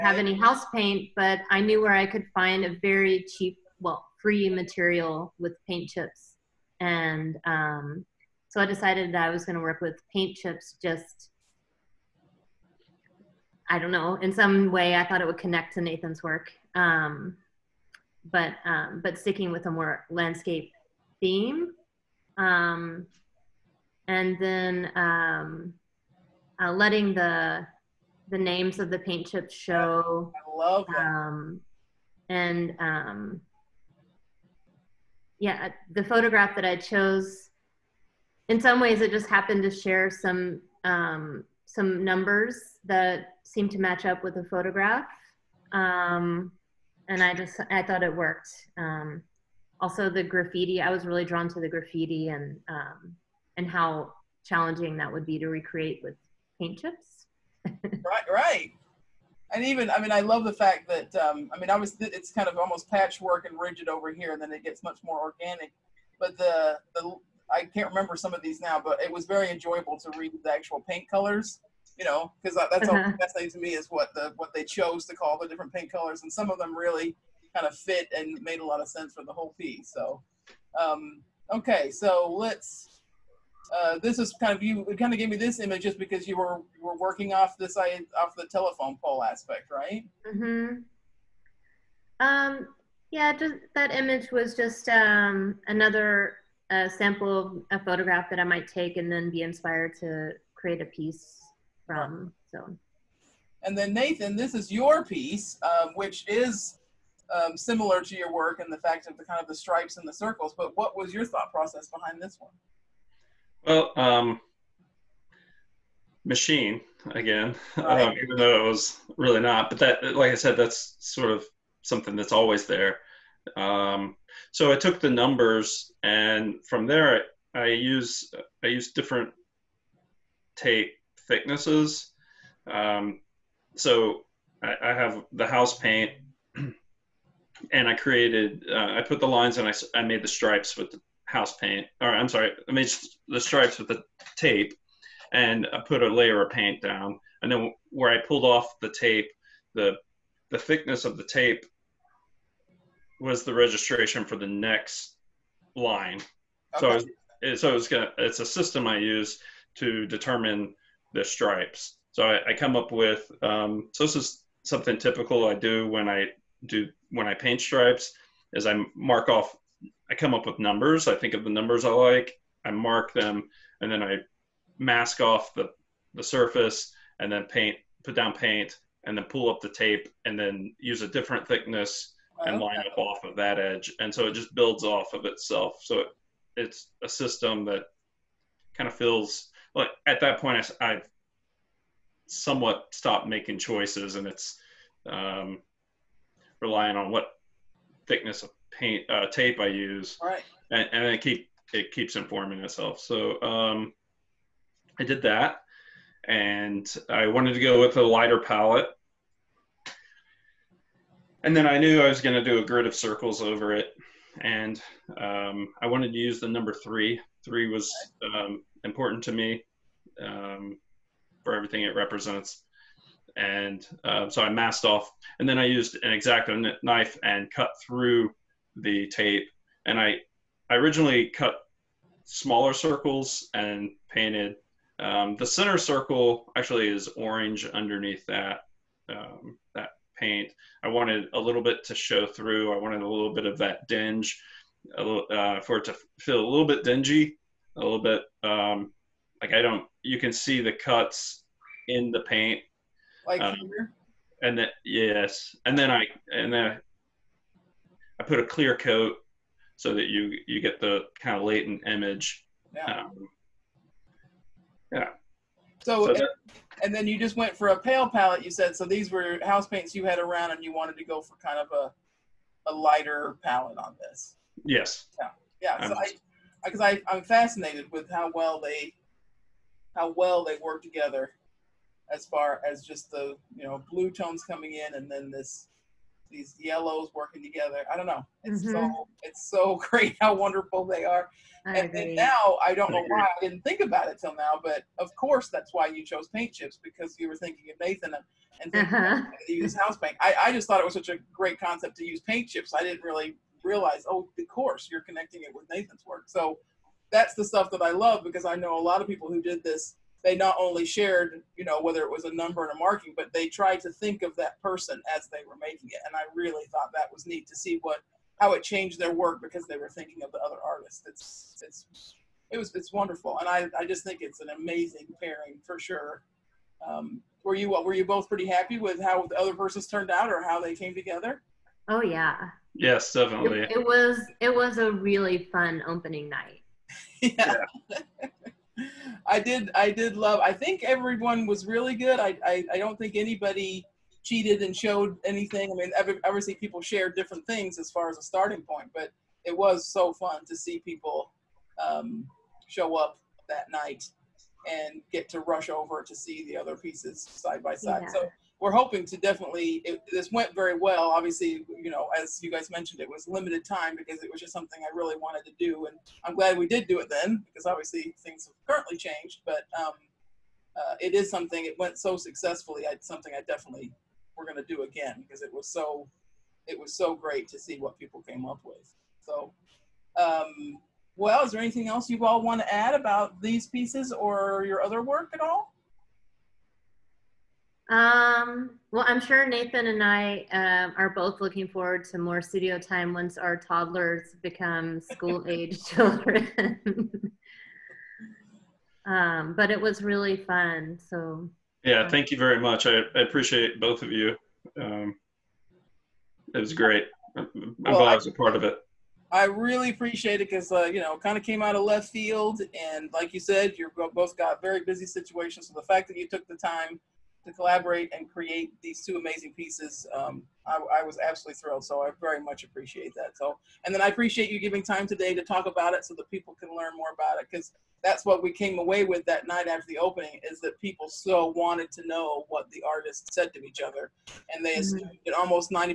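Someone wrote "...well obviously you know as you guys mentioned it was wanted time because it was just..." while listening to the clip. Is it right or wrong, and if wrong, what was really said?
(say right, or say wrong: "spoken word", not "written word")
wrong: "limited", not "wanted".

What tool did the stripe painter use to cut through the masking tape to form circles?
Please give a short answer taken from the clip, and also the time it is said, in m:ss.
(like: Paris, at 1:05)
exacto knife, at 3:46.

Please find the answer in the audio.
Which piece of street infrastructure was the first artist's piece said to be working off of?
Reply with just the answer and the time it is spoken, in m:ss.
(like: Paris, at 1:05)
telephone pole, at 1:28.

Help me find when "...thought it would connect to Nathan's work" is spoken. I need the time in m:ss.
0:15.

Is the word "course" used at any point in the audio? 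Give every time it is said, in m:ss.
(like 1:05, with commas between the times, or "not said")
4:55, 5:04.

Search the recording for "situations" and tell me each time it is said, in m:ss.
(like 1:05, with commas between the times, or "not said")
6:55.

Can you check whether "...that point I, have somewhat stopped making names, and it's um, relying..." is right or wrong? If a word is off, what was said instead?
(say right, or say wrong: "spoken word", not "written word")
wrong: "choices", not "names".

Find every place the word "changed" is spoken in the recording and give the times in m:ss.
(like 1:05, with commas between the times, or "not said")
5:18, 6:08.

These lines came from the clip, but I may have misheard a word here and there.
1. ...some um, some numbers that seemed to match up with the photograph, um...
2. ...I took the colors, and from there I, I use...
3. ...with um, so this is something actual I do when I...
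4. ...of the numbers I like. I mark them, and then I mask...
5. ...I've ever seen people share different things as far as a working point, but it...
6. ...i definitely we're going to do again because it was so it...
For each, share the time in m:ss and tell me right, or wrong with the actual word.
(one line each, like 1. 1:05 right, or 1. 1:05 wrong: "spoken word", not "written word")
1. 0:40 right
2. 2:04 wrong: "numbers", not "colors"
3. 2:42 wrong: "typical", not "actual"
4. 2:51 right
5. 5:45 wrong: "starting", not "working"
6. 6:13 right.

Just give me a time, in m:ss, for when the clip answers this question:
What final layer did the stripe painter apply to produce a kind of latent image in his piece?
4:18.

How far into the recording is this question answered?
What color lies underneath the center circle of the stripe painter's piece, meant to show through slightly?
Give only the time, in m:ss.
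3:57.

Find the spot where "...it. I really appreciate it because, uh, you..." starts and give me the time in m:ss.
6:48.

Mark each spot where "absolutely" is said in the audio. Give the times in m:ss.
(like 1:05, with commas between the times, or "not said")
7:01.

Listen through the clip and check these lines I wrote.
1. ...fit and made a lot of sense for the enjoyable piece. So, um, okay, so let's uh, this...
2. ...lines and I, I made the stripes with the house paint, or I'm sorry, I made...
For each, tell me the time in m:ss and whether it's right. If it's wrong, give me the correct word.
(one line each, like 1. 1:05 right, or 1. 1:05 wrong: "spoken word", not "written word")
1. 1:17 wrong: "whole", not "enjoyable"
2. 2:19 right.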